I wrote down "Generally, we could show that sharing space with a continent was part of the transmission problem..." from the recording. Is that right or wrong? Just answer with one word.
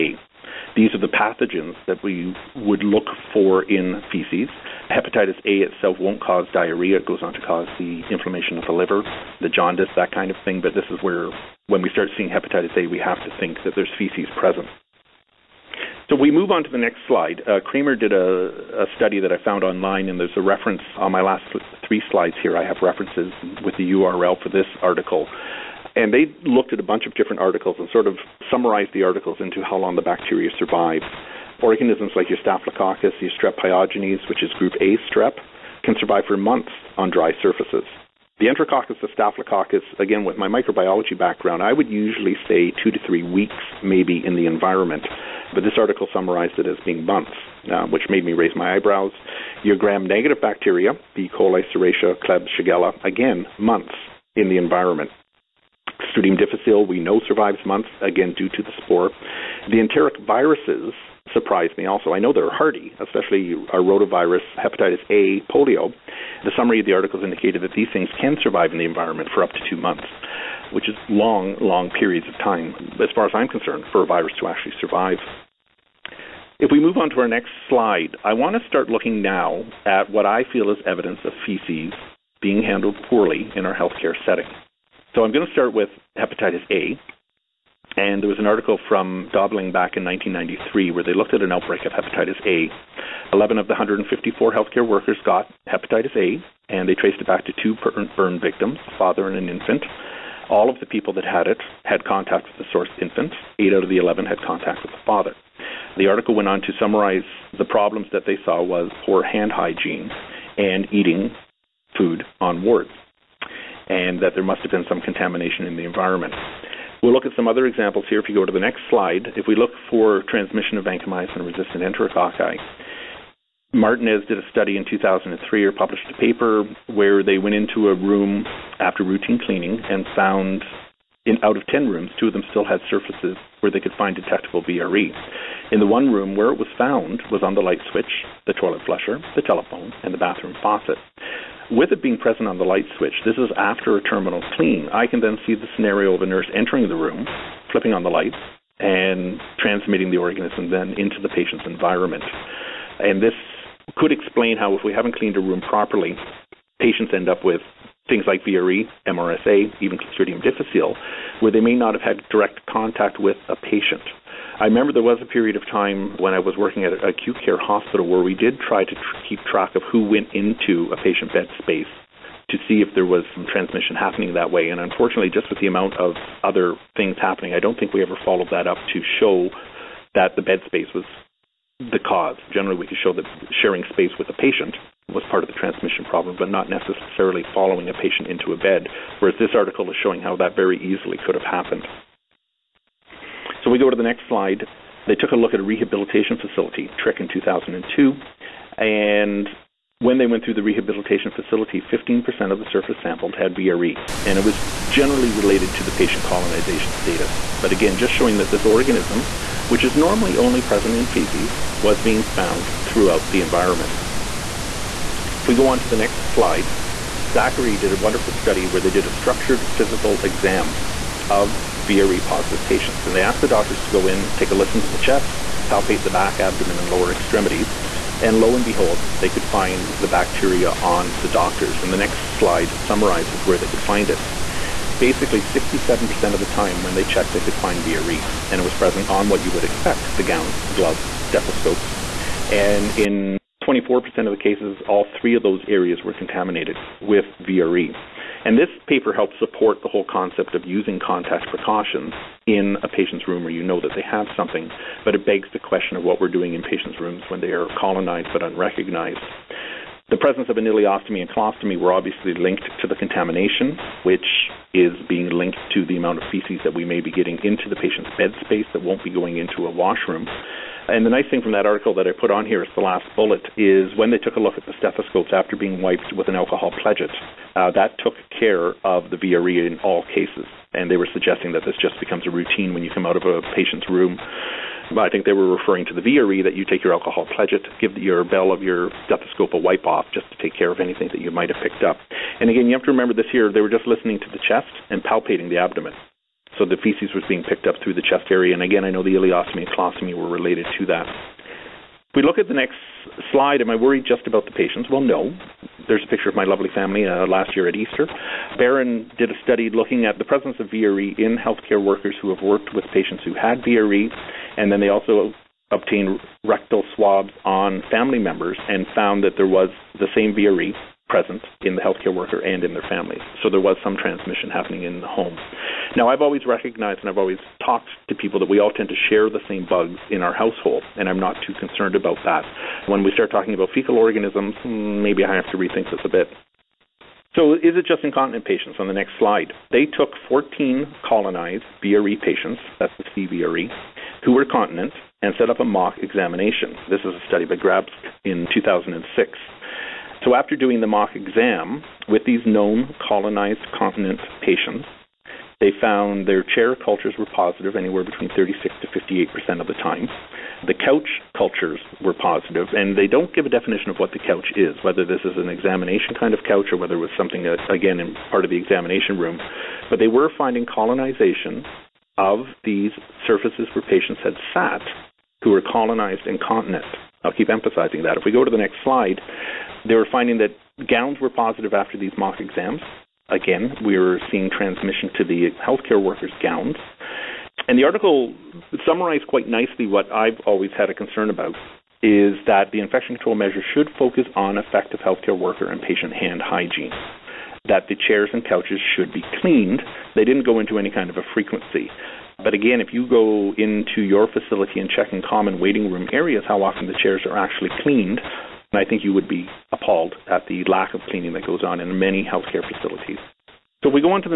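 wrong.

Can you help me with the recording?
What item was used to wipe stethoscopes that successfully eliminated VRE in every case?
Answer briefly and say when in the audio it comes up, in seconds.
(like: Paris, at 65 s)
alcohol pledget, at 276 s.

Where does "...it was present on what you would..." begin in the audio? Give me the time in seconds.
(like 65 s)
238 s.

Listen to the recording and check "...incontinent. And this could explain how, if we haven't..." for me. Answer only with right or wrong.
wrong.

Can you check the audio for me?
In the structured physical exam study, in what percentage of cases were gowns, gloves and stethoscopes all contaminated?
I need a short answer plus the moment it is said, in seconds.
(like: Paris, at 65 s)
24%, at 243 s.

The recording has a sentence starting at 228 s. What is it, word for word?
And lo and behold, they could find the bacteria on the doctors.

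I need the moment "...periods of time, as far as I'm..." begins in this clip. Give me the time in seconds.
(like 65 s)
71 s.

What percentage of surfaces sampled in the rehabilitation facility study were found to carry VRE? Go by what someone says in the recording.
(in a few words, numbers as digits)
15%.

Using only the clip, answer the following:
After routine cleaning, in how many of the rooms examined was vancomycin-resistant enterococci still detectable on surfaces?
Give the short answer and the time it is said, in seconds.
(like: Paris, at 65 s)
2, at 132 s.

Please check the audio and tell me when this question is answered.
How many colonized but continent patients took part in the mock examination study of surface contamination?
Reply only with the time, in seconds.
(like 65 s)
340 s.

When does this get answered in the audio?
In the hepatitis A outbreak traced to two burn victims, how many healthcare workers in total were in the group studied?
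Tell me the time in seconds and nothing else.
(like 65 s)
93 s.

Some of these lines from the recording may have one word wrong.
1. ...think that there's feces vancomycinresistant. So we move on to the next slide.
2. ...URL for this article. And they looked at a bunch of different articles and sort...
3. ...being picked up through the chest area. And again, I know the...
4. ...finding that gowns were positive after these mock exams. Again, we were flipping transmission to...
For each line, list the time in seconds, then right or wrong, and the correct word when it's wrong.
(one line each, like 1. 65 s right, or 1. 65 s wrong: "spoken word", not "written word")
1. 13 s wrong: "present", not "vancomycinresistant"
2. 23 s right
3. 297 s right
4. 380 s wrong: "seeing", not "flipping".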